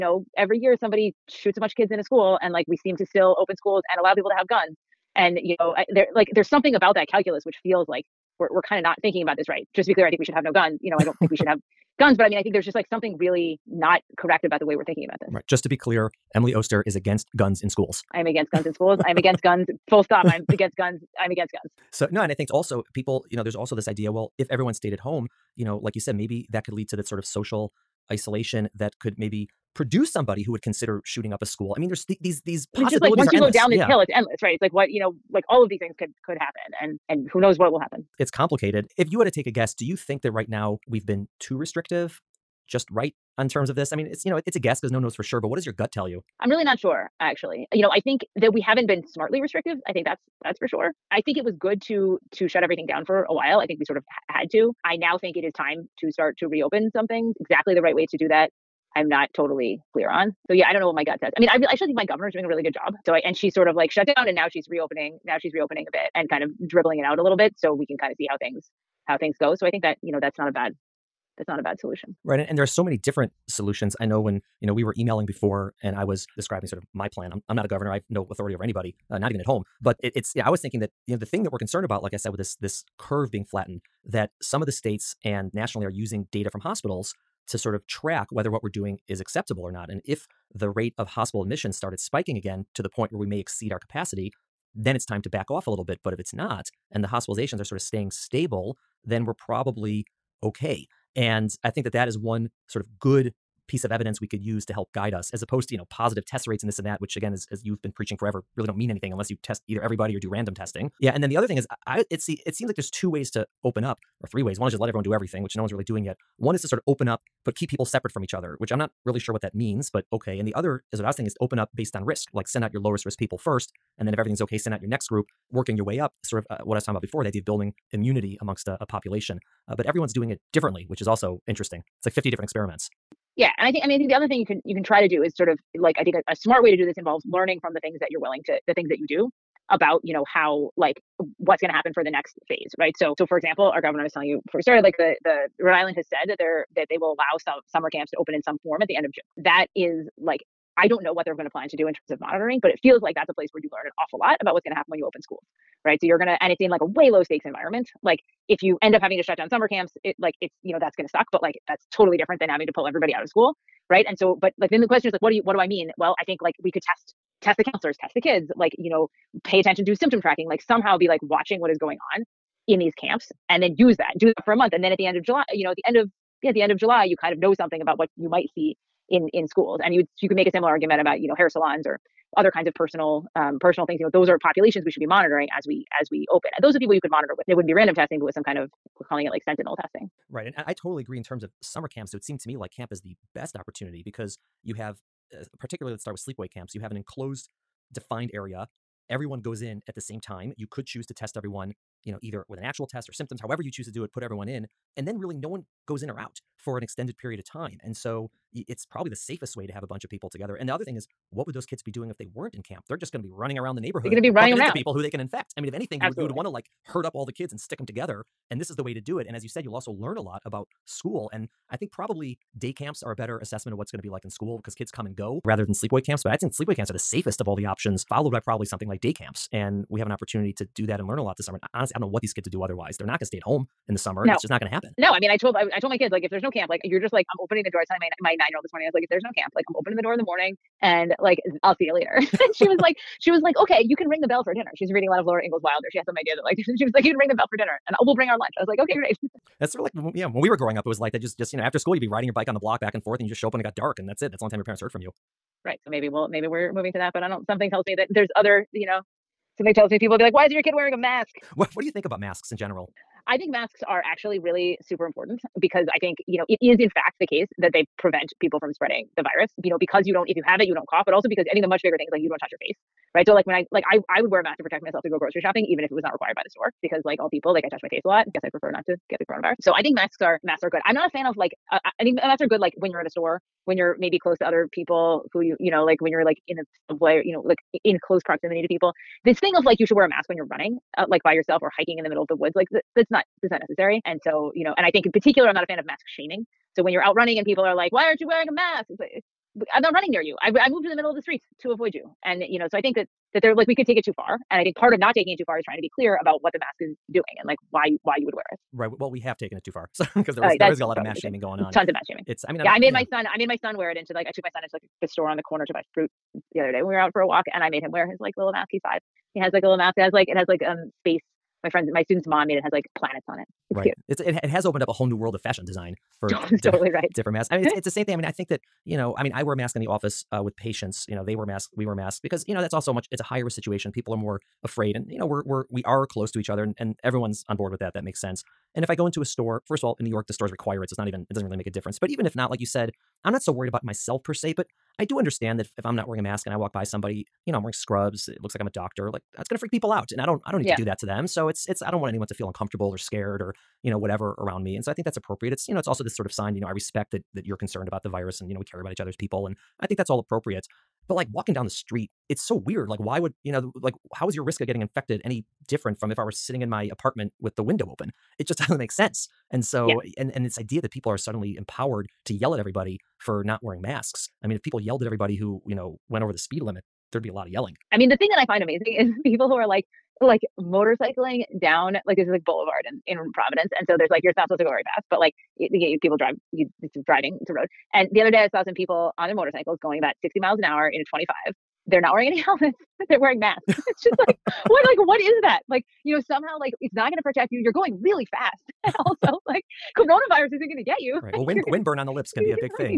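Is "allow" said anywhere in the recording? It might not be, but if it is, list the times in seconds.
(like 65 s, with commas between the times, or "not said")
3 s, 147 s.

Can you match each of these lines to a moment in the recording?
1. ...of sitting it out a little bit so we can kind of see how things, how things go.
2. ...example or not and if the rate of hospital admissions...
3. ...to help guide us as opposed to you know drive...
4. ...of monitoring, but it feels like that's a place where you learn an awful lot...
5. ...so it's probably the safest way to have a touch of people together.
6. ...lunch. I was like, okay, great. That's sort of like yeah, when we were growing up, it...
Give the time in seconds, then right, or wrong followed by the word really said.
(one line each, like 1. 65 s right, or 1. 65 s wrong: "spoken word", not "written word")
1. 66 s wrong: "dribbling", not "sitting"
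2. 89 s wrong: "acceptable", not "example"
3. 104 s wrong: "positive", not "drive"
4. 152 s right
5. 207 s wrong: "bunch", not "touch"
6. 248 s right.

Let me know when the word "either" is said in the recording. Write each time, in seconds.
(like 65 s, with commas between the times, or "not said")
109 s, 202 s.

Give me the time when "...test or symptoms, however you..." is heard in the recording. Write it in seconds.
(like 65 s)
202 s.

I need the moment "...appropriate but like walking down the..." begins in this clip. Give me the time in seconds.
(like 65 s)
360 s.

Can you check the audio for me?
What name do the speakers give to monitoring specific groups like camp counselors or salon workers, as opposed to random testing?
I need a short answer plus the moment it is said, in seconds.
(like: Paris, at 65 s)
sentinel testing, at 189 s.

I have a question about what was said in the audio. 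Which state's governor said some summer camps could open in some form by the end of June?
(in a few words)
Rhode Island.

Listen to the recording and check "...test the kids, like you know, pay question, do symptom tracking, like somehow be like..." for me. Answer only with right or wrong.
wrong.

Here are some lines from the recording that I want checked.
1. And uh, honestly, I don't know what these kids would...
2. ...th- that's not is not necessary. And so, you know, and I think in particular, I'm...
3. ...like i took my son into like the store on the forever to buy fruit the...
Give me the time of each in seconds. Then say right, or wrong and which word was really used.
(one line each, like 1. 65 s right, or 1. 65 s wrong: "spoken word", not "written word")
1. 231 s right
2. 292 s right
3. 314 s wrong: "corner", not "forever".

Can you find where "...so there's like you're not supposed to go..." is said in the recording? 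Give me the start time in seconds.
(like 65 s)
383 s.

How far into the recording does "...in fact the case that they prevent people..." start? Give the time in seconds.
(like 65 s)
266 s.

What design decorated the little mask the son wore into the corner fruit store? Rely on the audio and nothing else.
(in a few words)
planets.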